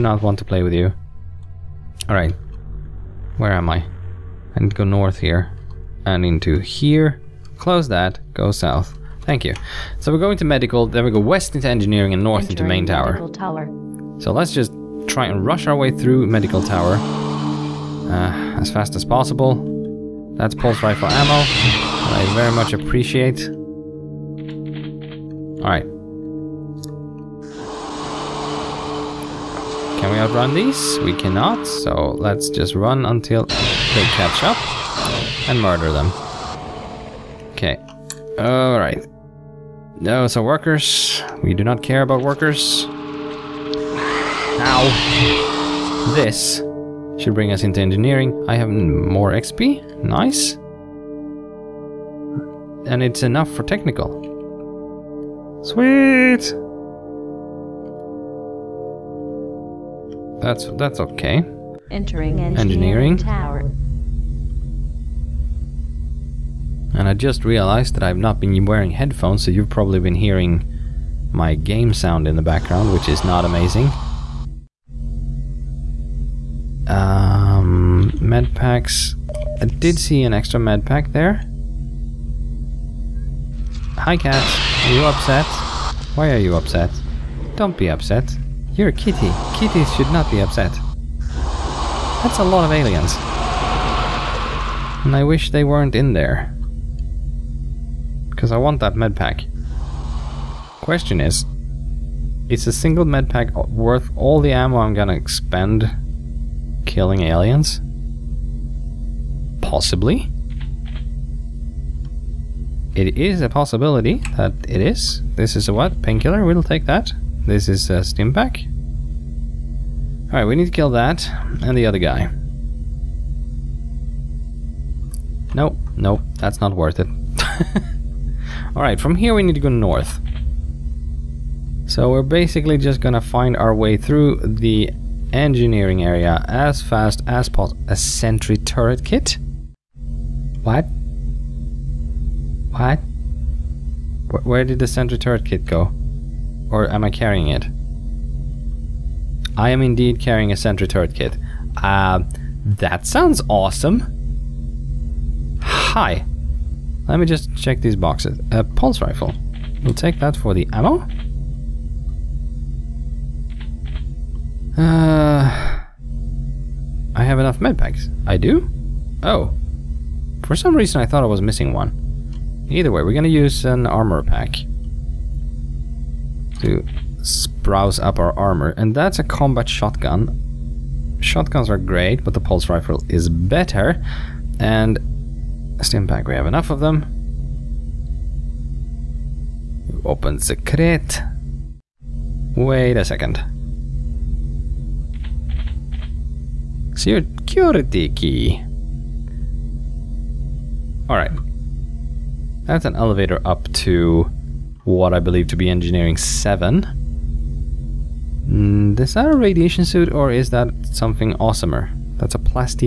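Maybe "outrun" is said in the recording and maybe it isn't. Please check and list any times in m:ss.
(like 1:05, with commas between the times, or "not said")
0:30.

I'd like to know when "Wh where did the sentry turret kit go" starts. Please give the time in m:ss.
2:24.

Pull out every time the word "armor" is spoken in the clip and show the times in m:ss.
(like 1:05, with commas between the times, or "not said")
2:53, 2:58.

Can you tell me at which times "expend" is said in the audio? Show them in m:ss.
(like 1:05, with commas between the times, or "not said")
1:45.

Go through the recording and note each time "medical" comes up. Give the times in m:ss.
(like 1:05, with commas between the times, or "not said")
0:10, 0:16.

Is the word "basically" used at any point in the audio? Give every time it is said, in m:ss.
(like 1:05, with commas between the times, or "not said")
2:12.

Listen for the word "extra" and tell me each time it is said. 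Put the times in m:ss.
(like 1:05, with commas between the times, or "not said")
1:20.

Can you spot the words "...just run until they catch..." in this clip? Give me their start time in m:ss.
0:32.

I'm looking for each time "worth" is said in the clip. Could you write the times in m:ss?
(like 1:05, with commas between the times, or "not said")
1:43, 2:06.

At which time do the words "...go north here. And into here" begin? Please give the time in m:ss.
0:04.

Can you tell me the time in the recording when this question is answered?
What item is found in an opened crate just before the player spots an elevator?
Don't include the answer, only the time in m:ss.
3:16.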